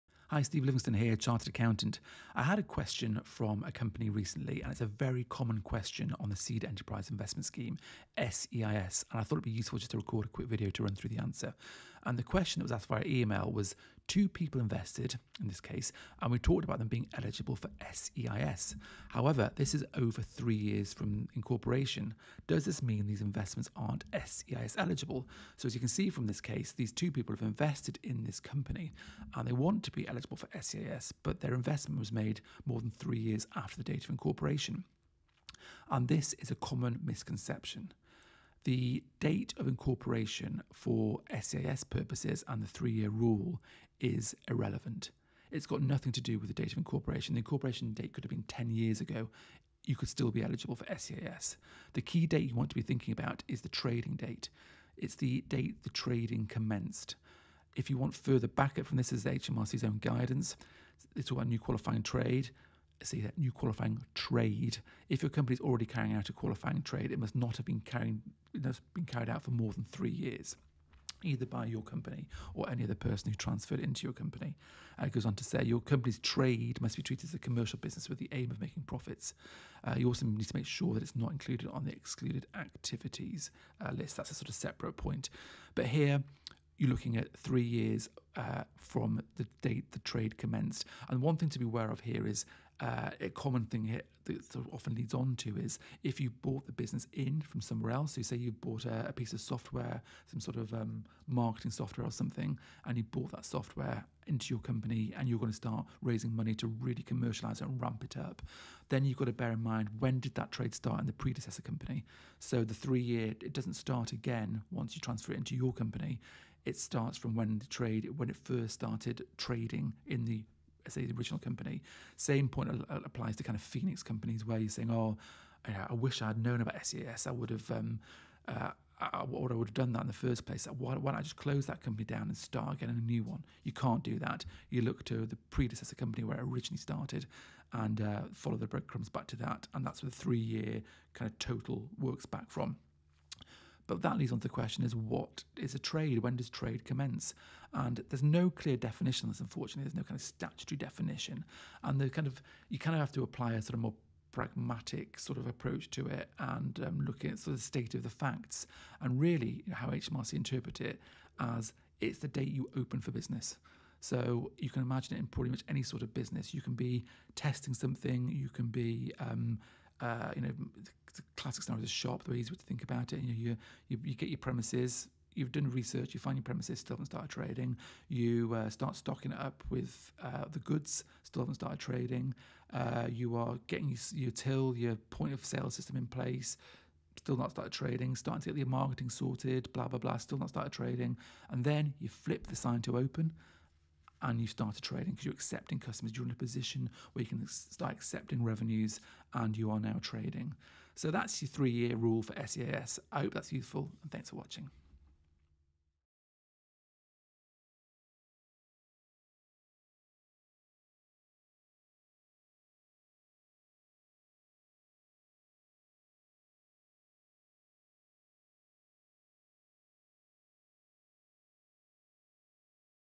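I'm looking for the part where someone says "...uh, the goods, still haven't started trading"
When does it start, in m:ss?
3:00.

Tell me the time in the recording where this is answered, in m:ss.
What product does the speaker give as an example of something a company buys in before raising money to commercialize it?
1:41.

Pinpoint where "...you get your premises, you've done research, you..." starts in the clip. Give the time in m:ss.
2:54.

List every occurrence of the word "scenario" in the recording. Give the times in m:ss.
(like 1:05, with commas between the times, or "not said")
2:51.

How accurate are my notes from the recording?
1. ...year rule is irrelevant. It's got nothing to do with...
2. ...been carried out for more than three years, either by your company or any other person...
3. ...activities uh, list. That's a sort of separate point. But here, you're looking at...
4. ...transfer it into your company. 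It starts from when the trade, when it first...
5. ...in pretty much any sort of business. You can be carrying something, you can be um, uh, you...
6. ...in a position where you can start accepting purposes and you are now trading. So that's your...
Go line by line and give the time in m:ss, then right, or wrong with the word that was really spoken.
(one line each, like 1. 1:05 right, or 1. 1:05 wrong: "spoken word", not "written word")
1. 0:42 right
2. 1:08 right
3. 1:22 right
4. 1:55 right
5. 2:45 wrong: "testing", not "carrying"
6. 3:16 wrong: "revenues", not "purposes".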